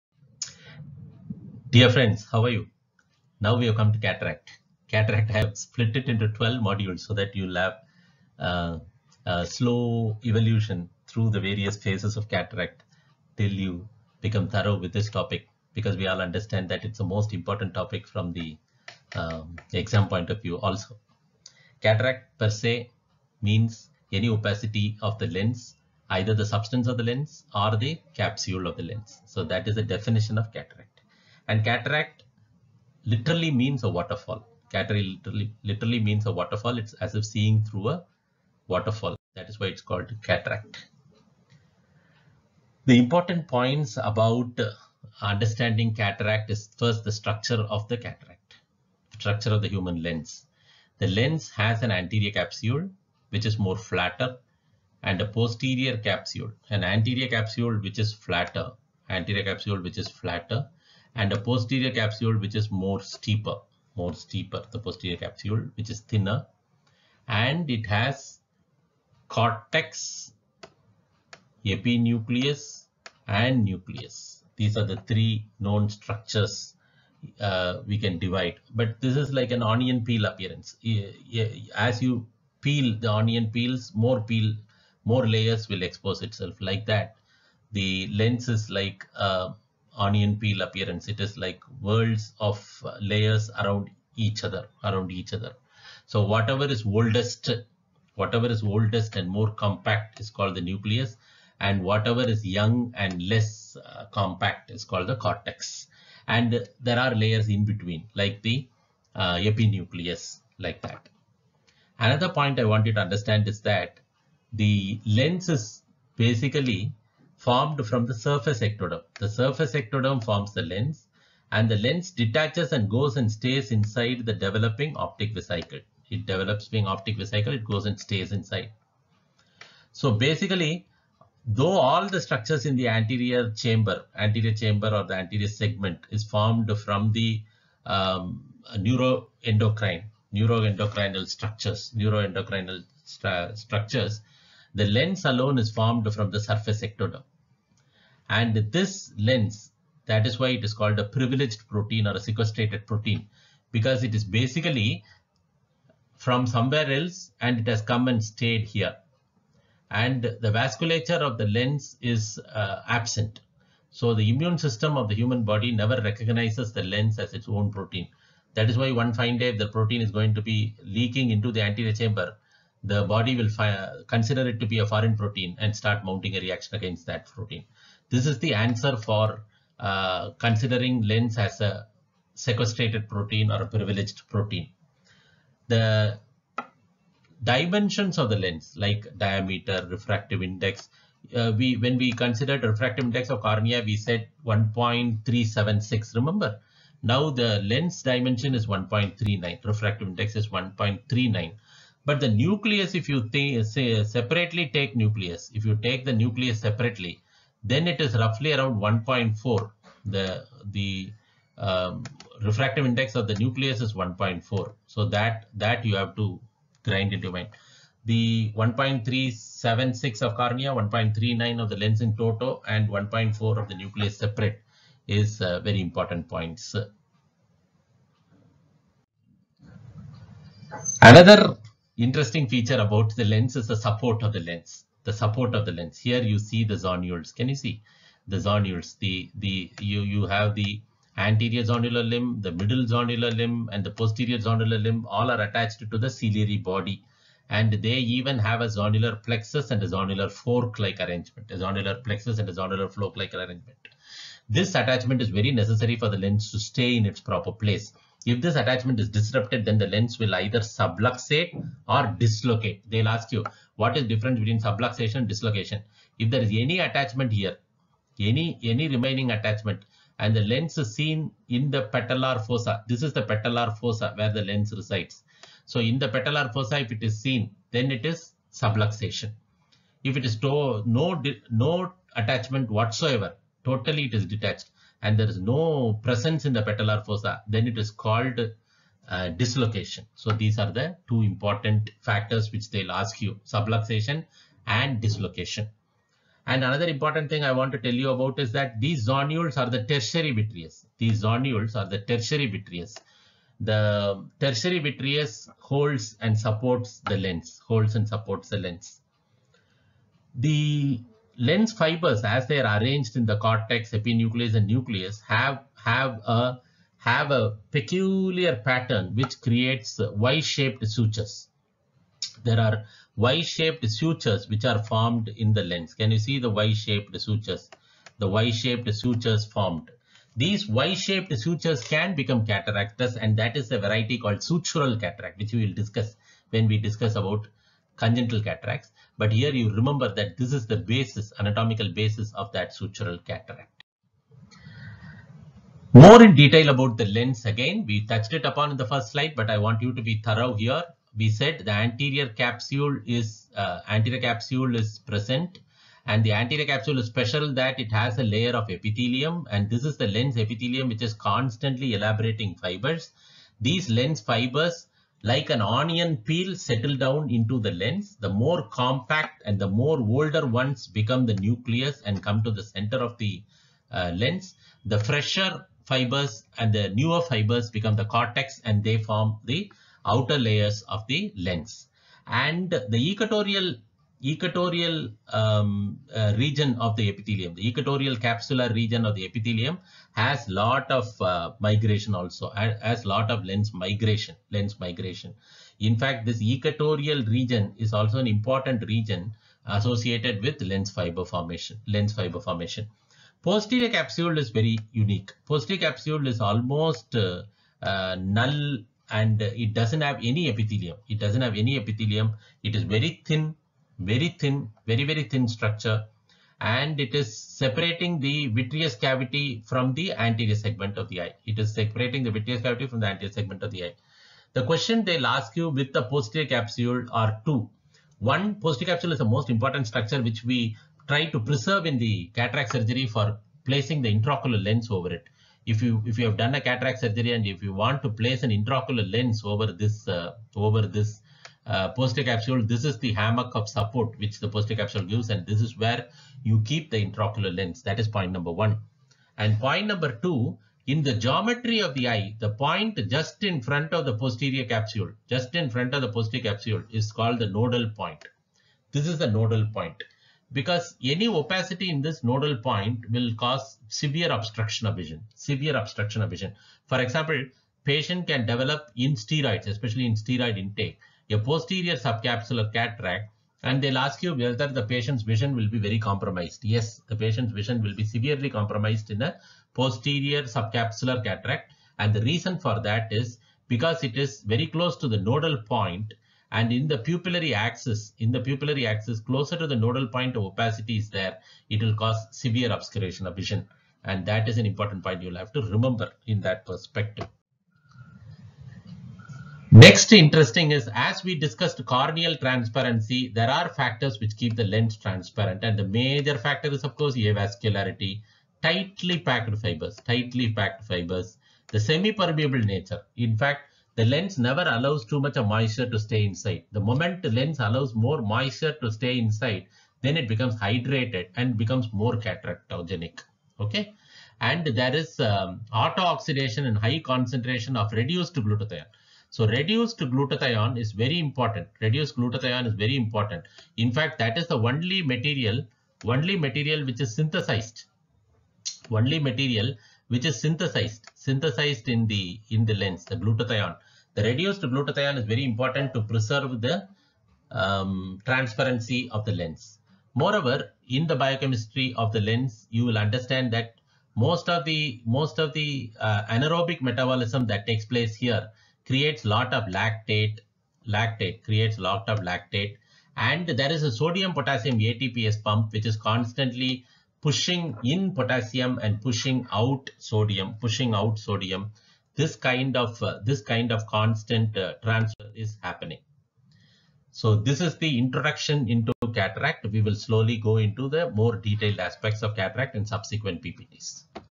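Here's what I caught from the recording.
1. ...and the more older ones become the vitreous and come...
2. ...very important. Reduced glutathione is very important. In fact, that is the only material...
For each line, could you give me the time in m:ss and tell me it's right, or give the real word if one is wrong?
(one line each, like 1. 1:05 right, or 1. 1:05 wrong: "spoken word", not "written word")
1. 6:09 wrong: "nucleus", not "vitreous"
2. 8:50 right.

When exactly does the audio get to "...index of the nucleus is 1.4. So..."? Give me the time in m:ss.
3:32.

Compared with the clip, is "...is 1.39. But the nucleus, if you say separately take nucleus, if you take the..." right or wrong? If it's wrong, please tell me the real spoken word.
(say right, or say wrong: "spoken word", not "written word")
right.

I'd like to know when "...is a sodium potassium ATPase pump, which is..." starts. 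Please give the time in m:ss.
9:23.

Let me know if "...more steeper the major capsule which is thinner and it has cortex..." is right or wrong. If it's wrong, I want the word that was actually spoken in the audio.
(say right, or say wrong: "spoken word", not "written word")
wrong: "posterior", not "major".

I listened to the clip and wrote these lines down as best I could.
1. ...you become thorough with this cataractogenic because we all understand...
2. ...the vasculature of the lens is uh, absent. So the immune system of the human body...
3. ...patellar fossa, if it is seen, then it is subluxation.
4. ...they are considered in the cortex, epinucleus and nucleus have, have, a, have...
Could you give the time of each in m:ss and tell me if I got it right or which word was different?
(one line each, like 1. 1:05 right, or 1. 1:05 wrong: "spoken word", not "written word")
1. 0:13 wrong: "topic", not "cataractogenic"
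2. 2:40 right
3. 4:36 right
4. 5:12 wrong: "arranged", not "considered".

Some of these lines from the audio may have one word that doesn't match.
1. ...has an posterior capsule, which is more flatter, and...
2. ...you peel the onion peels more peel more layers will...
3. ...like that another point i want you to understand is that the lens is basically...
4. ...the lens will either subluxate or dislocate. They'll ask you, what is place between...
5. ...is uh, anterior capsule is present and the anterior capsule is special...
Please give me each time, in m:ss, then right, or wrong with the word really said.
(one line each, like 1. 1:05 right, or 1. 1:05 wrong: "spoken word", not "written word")
1. 0:51 wrong: "anterior", not "posterior"
2. 1:22 right
3. 1:50 right
4. 4:19 wrong: "difference", not "place"
5. 5:53 right.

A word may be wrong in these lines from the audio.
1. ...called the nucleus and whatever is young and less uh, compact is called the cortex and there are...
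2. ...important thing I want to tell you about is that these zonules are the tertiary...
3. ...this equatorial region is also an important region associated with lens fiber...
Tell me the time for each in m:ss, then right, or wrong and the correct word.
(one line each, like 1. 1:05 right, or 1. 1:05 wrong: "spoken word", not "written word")
1. 1:40 right
2. 4:56 right
3. 6:36 right.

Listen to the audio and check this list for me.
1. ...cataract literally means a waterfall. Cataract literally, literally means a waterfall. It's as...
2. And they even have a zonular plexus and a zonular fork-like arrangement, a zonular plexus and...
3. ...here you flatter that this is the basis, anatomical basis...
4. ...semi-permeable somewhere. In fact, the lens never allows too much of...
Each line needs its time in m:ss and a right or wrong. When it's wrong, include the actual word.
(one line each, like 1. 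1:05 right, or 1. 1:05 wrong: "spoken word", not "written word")
1. 0:31 right
2. 4:07 right
3. 5:39 wrong: "remember", not "flatter"
4. 8:31 wrong: "nature", not "somewhere".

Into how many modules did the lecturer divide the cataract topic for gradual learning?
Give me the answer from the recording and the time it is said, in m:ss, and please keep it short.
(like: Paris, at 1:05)
12, at 0:06.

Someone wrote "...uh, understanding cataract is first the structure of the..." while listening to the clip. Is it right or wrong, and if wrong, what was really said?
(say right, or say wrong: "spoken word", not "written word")
right.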